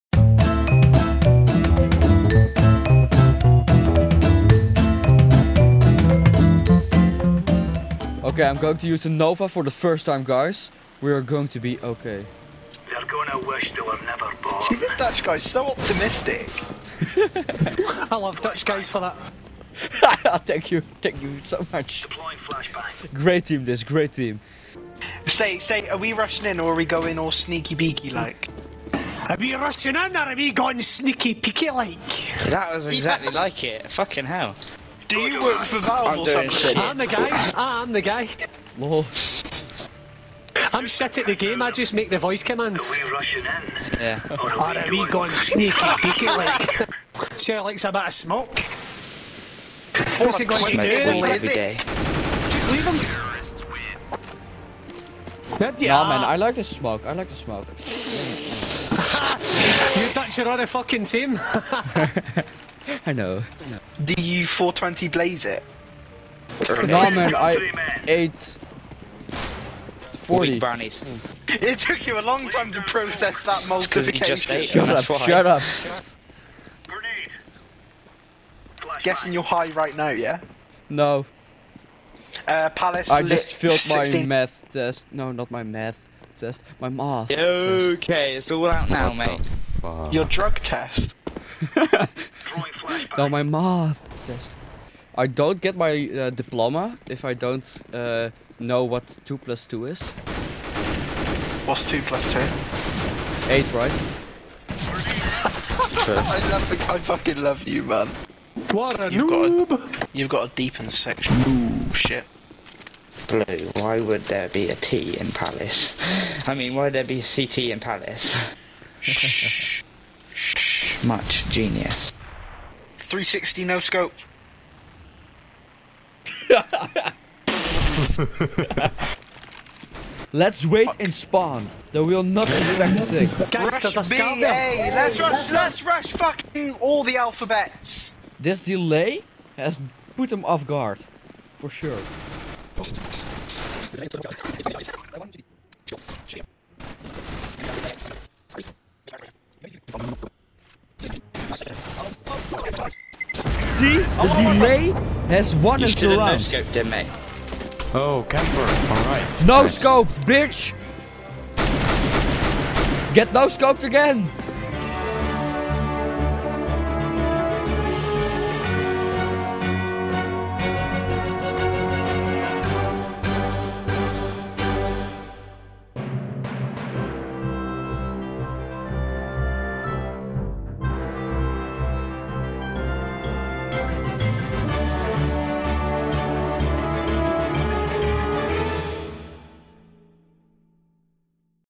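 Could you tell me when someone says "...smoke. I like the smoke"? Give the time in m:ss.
0:56.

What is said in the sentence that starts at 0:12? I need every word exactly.
They're gonna wish they were never born.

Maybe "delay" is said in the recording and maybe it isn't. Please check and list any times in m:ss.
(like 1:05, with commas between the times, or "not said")
2:18, 2:34.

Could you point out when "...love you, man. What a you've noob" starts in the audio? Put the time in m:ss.
1:47.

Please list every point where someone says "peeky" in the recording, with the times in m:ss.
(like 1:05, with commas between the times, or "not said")
0:31, 0:45.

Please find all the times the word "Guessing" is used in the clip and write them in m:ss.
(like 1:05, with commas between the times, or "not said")
1:19.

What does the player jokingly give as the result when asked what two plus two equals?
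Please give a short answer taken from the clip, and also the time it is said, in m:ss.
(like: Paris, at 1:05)
8, at 1:43.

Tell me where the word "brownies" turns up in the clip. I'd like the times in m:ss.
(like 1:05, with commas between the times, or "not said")
1:10.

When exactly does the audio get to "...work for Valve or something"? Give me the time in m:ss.
0:35.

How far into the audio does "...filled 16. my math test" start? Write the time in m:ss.
1:23.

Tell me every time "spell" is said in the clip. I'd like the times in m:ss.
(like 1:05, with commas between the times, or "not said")
not said.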